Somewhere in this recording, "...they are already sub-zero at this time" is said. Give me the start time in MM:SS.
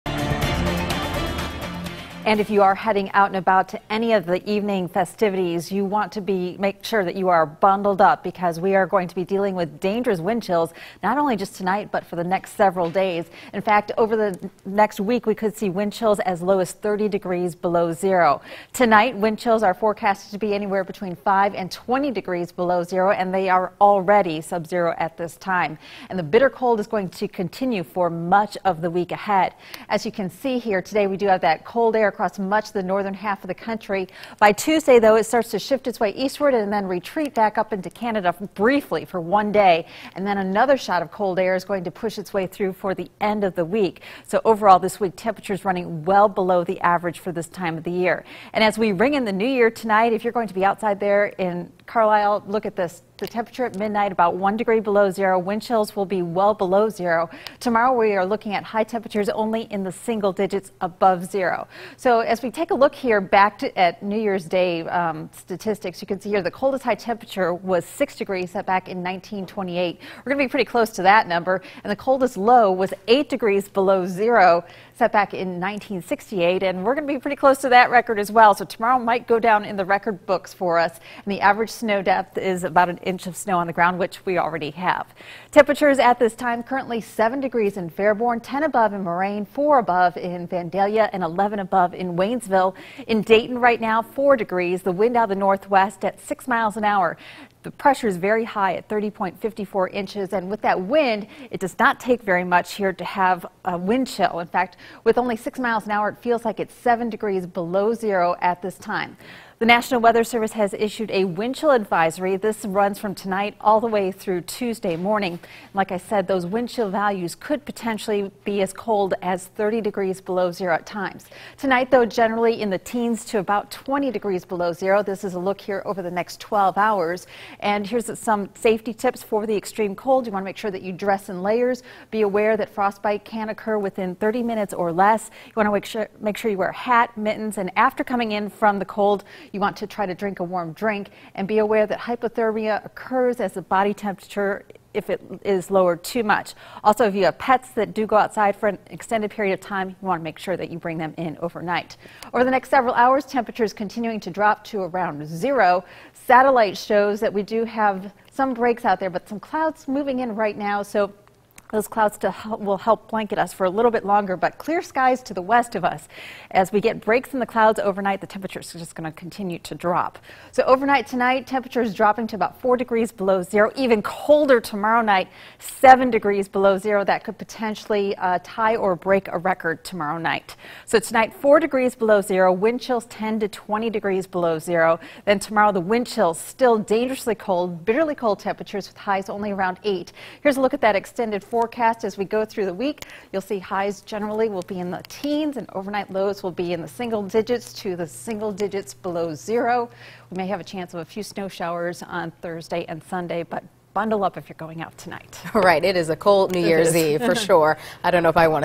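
00:23.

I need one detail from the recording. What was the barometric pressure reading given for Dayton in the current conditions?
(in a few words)
30.54 inches.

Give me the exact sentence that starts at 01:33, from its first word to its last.
In Dayton right now, 4 degrees.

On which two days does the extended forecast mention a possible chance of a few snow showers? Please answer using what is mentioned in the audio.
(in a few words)
Thursday and Sunday.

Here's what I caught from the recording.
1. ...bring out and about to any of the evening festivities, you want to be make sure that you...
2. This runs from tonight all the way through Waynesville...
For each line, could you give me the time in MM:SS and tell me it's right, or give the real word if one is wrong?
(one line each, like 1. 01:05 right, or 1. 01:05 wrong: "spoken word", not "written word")
1. 00:02 wrong: "heading", not "bring"
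2. 01:52 wrong: "Tuesday", not "Waynesville".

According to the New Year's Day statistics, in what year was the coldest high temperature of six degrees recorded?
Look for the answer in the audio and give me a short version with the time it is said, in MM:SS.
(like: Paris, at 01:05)
1928, at 01:09.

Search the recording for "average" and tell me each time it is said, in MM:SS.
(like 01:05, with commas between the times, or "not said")
00:46, 01:21.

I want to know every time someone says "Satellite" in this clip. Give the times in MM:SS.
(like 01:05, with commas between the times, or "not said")
02:36.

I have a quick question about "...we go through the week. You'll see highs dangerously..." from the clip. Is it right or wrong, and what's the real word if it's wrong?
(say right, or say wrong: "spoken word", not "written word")
wrong: "generally", not "dangerously".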